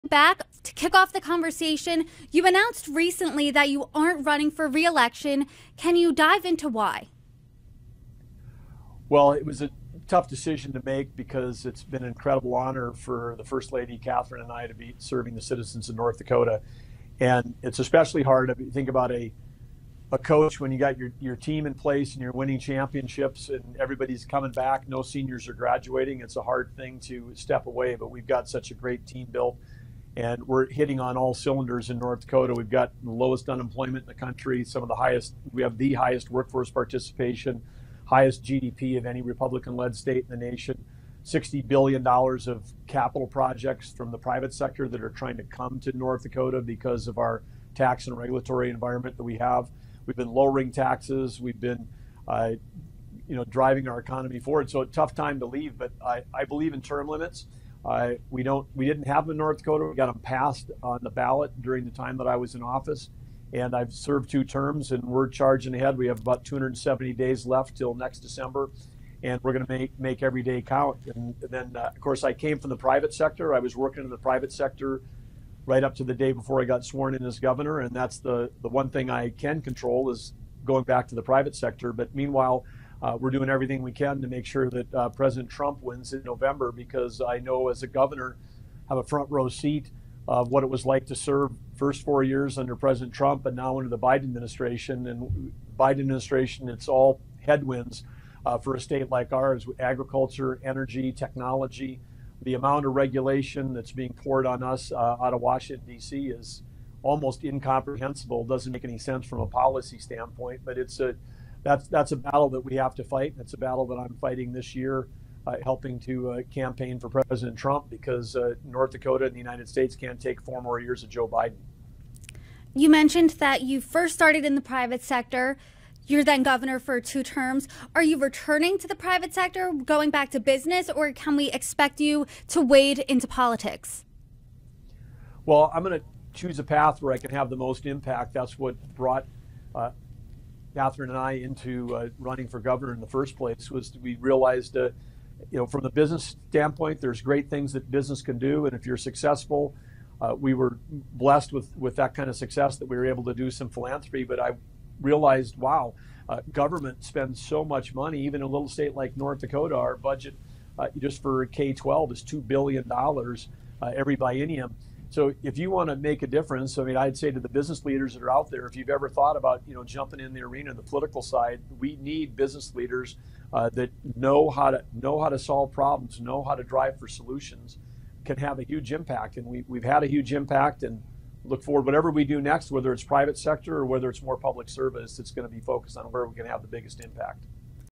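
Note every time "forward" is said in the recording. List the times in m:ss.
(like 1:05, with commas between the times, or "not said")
0:54, 3:01.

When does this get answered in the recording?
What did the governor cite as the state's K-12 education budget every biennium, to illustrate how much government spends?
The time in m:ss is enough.
2:42.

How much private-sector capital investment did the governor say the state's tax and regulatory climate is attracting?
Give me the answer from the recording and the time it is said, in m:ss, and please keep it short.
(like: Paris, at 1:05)
$60 billion, at 0:41.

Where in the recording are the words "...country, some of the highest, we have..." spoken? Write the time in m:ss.
0:34.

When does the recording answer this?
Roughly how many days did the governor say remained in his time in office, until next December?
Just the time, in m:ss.
1:06.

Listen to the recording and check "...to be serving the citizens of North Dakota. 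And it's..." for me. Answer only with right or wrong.
right.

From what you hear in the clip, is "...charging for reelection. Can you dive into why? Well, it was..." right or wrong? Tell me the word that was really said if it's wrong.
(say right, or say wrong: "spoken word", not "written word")
wrong: "running", not "charging".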